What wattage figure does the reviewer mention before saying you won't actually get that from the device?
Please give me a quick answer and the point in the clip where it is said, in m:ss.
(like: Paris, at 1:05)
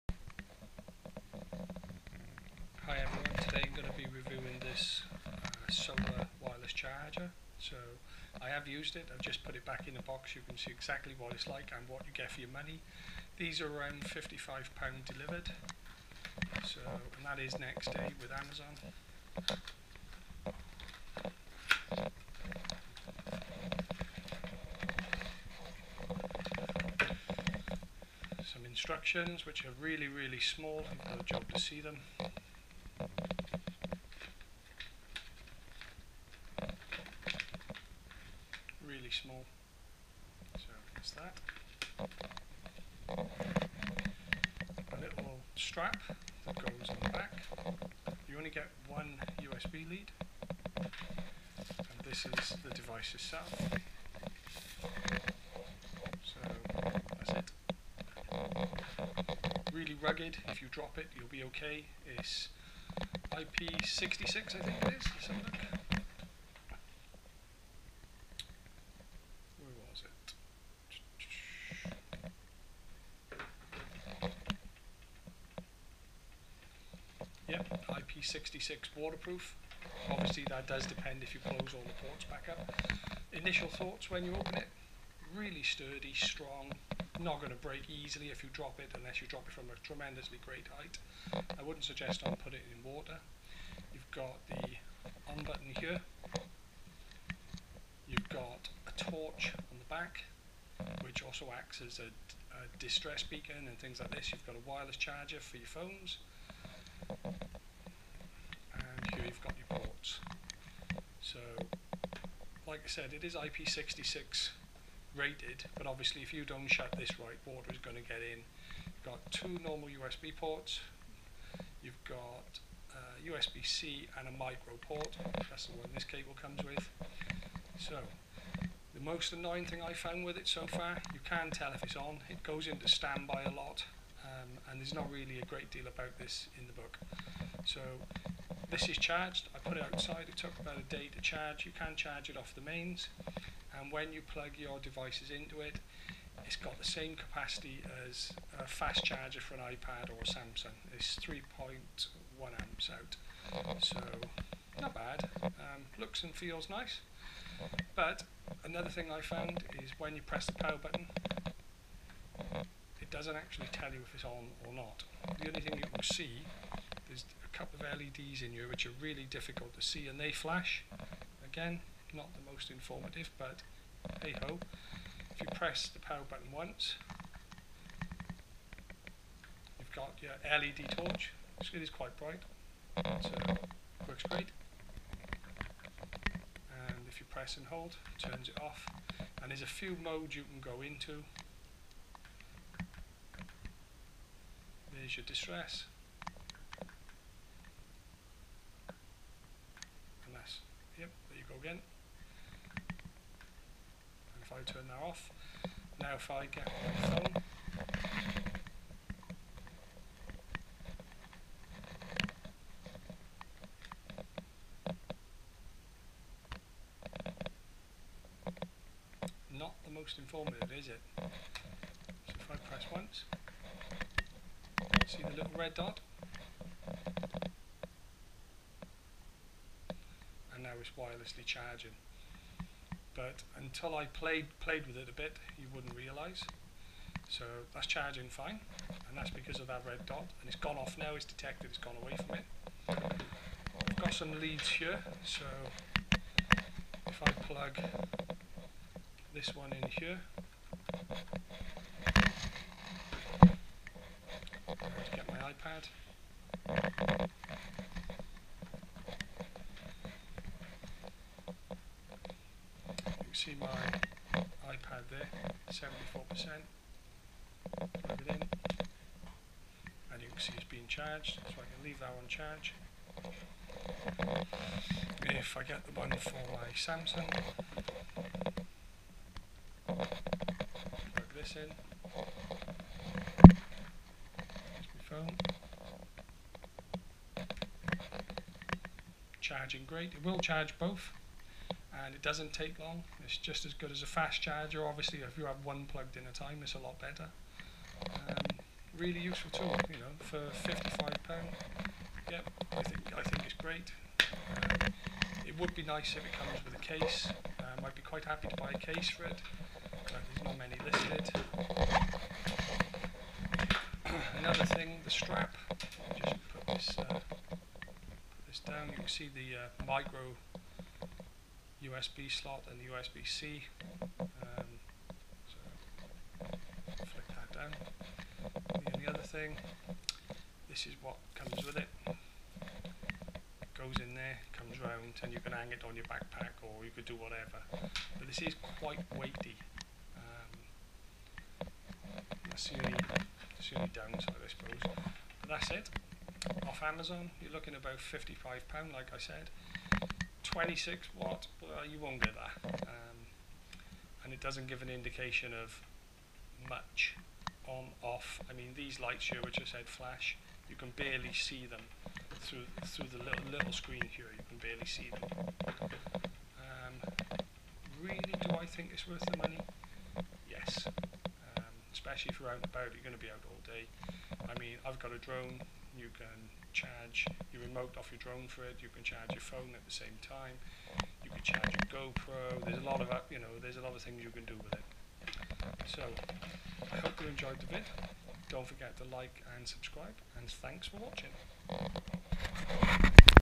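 26 watt, at 5:50.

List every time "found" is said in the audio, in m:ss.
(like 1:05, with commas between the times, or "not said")
2:09, 2:39.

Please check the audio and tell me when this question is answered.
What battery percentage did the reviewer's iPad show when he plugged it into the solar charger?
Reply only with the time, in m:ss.
4:25.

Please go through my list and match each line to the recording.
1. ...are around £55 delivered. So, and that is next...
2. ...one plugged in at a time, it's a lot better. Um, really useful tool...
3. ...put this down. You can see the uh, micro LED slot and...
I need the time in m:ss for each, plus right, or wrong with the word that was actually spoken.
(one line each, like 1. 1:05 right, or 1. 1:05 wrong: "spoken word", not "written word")
1. 0:13 right
2. 4:55 right
3. 5:17 wrong: "USB", not "LED".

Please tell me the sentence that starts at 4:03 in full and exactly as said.
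I've got some leads here, so if I plug this one in here, get my iPad.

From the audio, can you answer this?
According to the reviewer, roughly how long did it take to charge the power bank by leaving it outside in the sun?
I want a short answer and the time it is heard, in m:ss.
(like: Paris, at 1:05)
About a day, at 2:20.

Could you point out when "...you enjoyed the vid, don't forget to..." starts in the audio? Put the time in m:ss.
6:27.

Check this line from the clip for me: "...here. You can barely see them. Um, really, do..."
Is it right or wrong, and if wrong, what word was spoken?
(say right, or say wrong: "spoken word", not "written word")
right.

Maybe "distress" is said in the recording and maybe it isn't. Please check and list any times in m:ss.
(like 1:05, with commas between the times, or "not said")
1:42, 3:15.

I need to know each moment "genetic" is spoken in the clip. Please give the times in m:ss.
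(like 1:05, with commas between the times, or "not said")
not said.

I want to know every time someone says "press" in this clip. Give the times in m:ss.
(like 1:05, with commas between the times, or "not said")
2:40, 2:55, 3:07, 3:42.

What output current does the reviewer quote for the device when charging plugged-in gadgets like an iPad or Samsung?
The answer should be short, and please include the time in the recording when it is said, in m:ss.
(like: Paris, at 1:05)
3.1 amps, at 2:31.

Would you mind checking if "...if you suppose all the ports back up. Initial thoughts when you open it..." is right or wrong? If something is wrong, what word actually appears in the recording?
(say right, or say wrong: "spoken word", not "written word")
wrong: "close", not "suppose".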